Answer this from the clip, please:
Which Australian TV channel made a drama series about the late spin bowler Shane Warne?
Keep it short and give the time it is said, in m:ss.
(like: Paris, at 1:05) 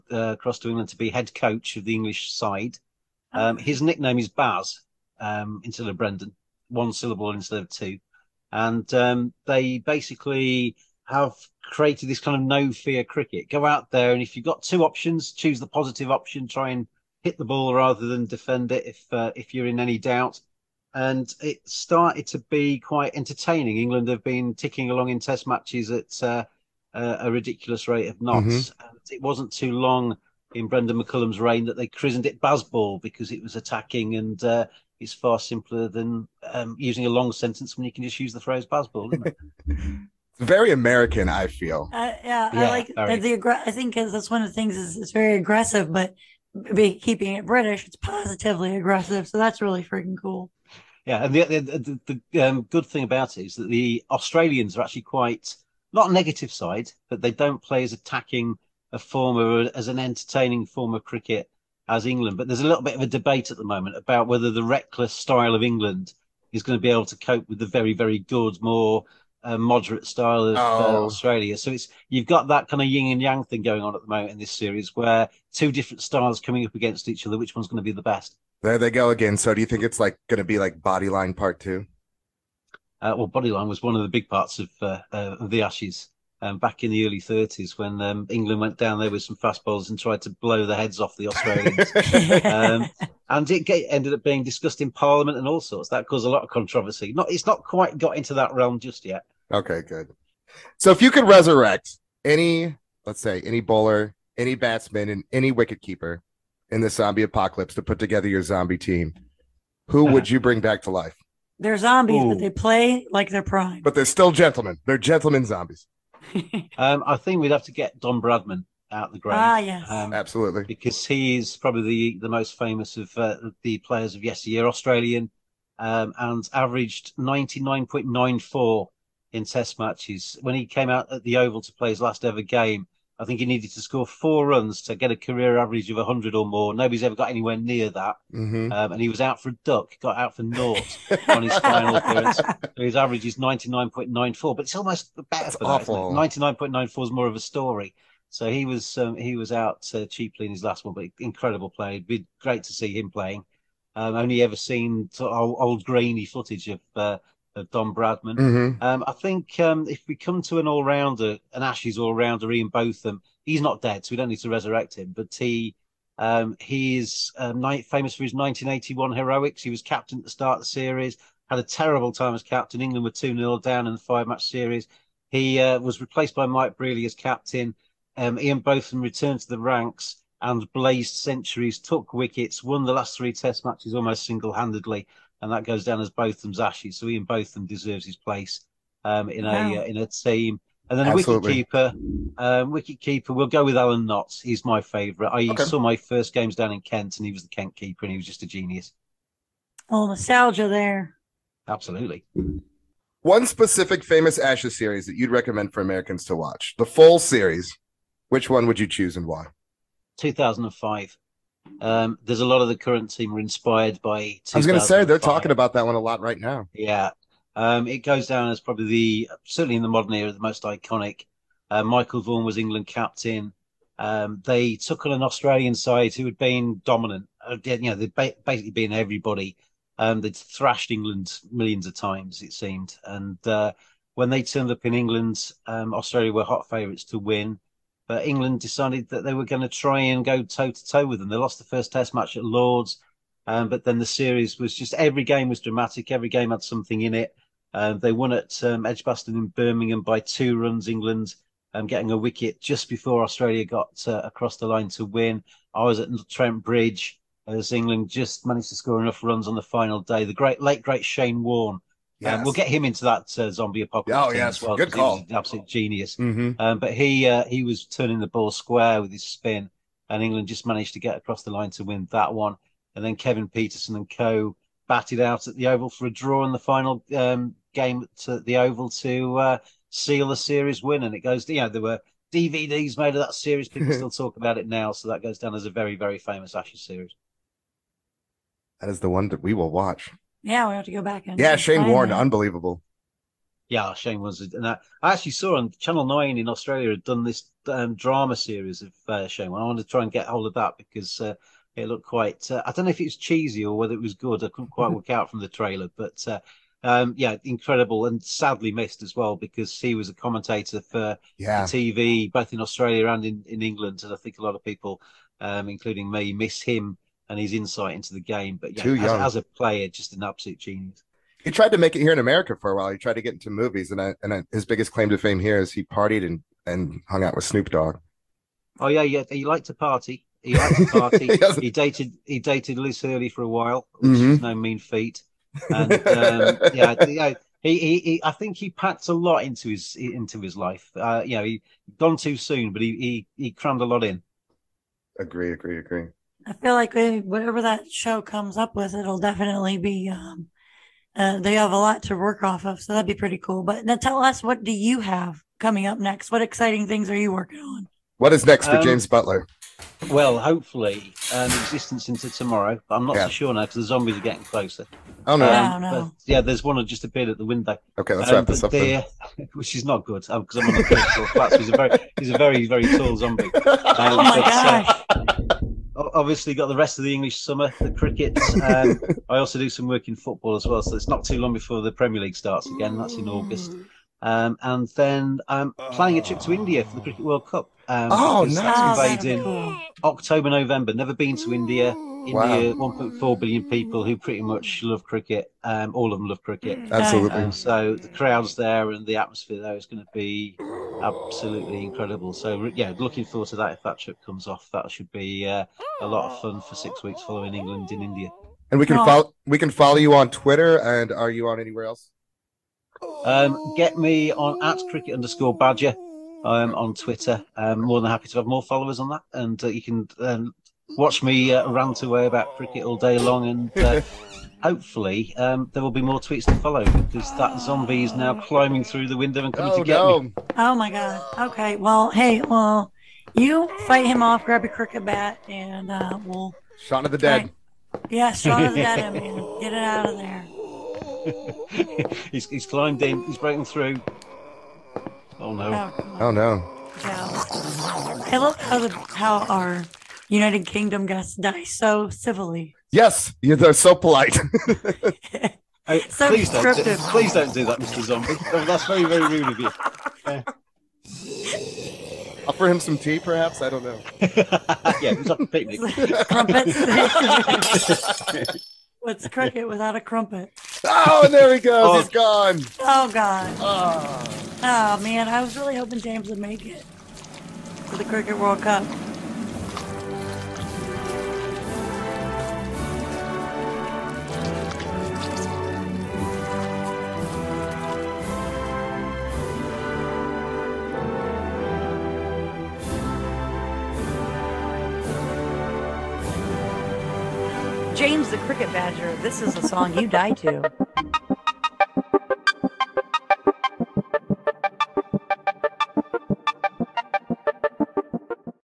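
Channel Nine, at 4:55.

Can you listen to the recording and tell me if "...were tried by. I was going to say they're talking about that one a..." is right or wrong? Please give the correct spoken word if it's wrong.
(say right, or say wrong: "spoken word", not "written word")
wrong: "inspired", not "tried".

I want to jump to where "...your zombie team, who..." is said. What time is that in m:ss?
1:48.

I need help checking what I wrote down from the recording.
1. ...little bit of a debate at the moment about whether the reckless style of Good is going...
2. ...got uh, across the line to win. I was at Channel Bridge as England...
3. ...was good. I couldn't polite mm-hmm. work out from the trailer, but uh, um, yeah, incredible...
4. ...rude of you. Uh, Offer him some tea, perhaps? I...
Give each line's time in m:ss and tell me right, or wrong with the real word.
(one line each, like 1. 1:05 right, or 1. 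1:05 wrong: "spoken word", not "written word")
1. 1:02 wrong: "England", not "Good"
2. 4:13 wrong: "Trent", not "Channel"
3. 5:04 wrong: "quite", not "polite"
4. 7:39 right.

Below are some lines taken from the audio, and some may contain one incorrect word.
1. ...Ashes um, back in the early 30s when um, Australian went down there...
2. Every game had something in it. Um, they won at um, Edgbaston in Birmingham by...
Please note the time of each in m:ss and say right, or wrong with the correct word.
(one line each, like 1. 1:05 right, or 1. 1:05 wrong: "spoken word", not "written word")
1. 1:25 wrong: "England", not "Australian"
2. 4:06 right.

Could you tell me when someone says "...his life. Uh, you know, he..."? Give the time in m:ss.
5:40.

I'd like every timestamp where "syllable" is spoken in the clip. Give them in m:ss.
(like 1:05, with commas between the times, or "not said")
0:06.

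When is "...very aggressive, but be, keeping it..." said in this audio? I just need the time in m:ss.
0:45.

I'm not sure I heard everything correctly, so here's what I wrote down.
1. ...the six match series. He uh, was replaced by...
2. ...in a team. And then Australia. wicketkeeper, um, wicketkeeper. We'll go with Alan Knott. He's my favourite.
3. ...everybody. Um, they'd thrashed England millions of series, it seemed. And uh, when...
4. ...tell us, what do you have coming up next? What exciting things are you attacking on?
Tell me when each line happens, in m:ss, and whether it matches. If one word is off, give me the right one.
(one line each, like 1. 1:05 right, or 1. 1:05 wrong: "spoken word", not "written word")
1. 2:53 wrong: "five", not "six"
2. 3:09 wrong: "Absolutely", not "Australia"
3. 3:48 wrong: "times", not "series"
4. 5:53 wrong: "working", not "attacking".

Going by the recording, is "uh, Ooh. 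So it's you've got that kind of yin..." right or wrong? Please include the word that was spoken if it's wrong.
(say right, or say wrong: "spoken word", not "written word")
wrong: "Australia", not "Ooh".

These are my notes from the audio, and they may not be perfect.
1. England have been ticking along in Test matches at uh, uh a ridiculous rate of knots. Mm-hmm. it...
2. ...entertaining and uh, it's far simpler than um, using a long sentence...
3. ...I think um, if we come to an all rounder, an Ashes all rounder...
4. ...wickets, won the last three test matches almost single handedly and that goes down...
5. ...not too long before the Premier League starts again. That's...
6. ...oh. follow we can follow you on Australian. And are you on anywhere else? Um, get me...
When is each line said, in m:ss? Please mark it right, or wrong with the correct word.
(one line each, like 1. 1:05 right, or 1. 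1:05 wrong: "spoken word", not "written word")
1. 0:23 right
2. 0:33 wrong: "attacking", not "entertaining"
3. 2:39 right
4. 3:02 right
5. 6:21 right
6. 6:48 wrong: "Twitter", not "Australian".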